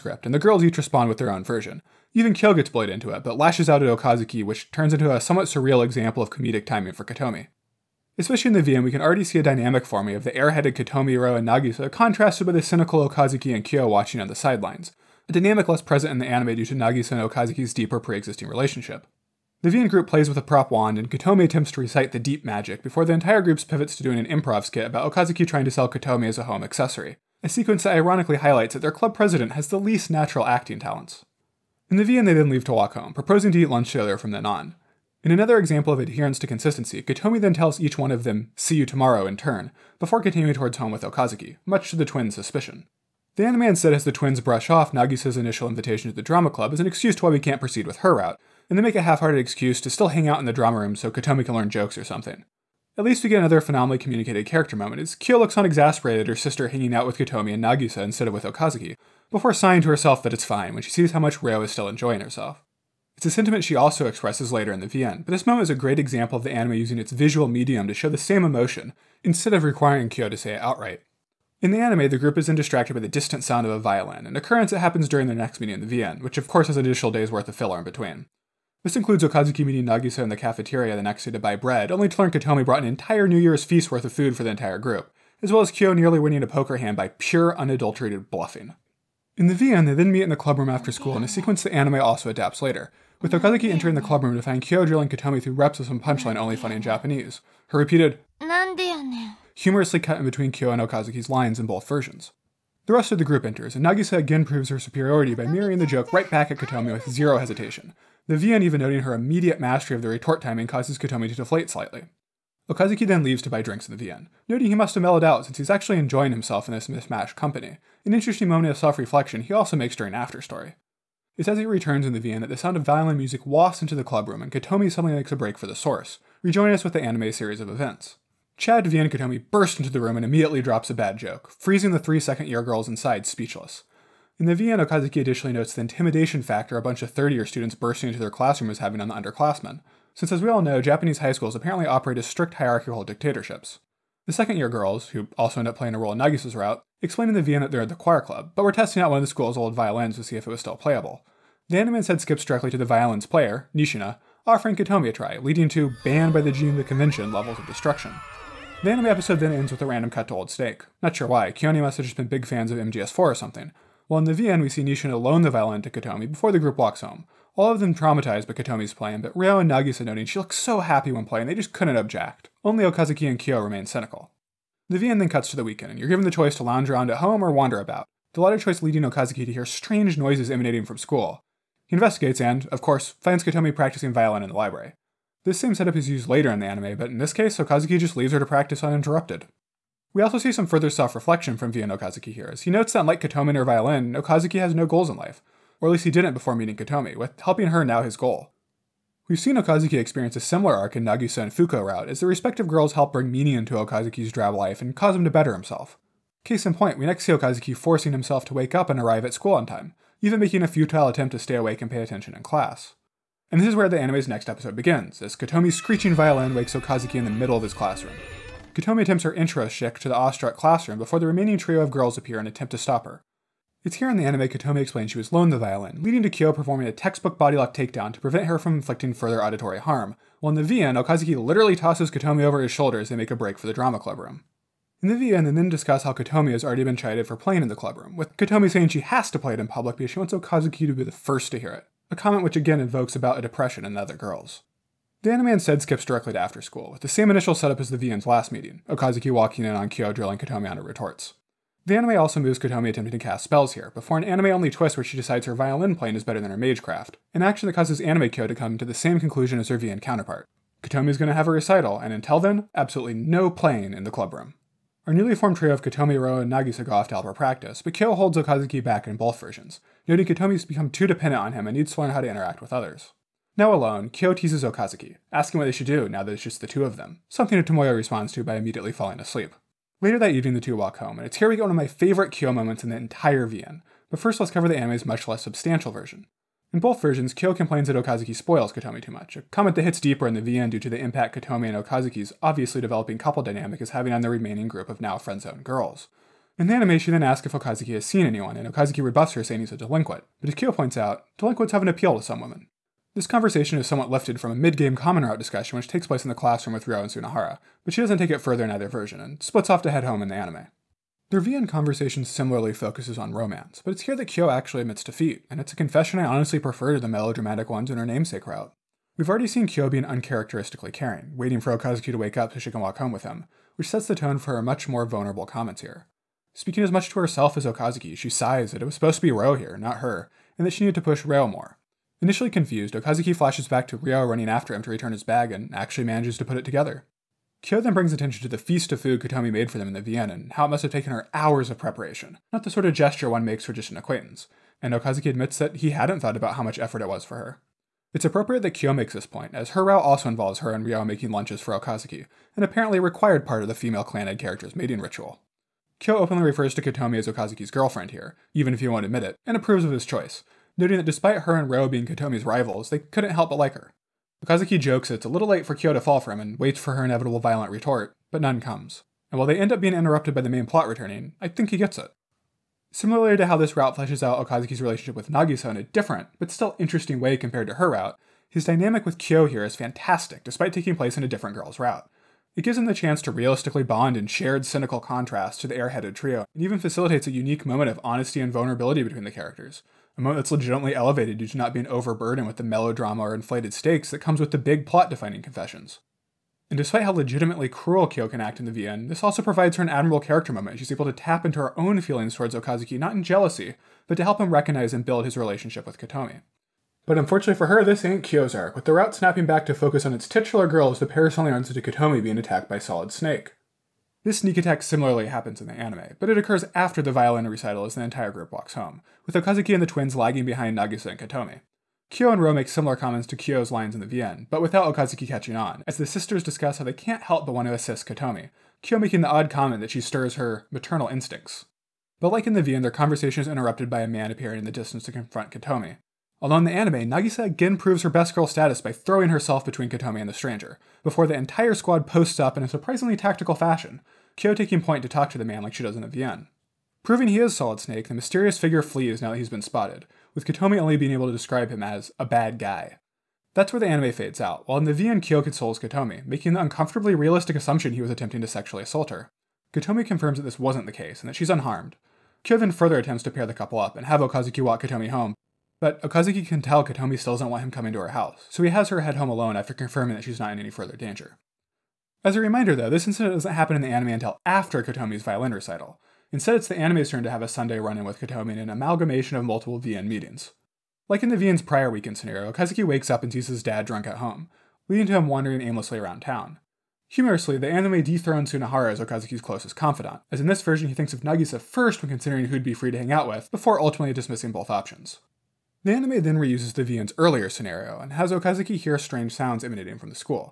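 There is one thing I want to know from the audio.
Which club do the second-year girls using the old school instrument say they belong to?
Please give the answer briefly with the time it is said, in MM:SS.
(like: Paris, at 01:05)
Choir club, at 02:27.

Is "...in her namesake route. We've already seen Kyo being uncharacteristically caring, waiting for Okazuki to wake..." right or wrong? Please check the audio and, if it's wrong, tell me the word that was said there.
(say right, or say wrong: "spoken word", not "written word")
right.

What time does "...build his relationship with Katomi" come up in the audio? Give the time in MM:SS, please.
06:45.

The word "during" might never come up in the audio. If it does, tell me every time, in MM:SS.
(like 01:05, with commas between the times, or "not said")
01:15, 01:59.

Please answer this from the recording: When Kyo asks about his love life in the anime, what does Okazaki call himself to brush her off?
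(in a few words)
A delinquent.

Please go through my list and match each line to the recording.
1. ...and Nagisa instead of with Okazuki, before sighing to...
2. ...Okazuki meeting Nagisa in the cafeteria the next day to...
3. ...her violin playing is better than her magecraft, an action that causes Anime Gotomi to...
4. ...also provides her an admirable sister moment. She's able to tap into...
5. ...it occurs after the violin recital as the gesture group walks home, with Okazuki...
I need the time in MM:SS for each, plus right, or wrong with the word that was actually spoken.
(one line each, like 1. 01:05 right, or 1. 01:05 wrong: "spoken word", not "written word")
1. 00:57 right
2. 01:19 right
3. 04:15 wrong: "Kyo", not "Gotomi"
4. 06:39 wrong: "character", not "sister"
5. 06:56 wrong: "entire", not "gesture".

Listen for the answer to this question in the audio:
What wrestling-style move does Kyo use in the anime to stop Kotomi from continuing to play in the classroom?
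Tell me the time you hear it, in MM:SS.
03:47.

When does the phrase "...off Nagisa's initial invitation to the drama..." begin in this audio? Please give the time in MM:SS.
00:44.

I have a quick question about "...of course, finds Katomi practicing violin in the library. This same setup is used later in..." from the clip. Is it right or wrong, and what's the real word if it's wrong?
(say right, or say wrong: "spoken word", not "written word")
right.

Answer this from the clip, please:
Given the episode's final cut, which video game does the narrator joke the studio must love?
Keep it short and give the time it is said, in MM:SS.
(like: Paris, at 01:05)
MGS4, at 02:42.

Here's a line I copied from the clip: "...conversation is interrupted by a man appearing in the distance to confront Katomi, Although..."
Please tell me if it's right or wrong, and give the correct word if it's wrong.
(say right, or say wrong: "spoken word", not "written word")
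right.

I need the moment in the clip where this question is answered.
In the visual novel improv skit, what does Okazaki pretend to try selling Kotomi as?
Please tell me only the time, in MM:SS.
00:26.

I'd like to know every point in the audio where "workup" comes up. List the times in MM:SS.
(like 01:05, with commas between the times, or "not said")
not said.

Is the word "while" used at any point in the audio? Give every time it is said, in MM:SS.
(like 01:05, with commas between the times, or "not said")
02:44, 03:50, 06:09, 07:34.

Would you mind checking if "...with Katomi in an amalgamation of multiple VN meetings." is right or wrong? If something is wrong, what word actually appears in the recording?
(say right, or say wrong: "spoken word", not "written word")
right.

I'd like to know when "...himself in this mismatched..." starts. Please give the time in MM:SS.
01:56.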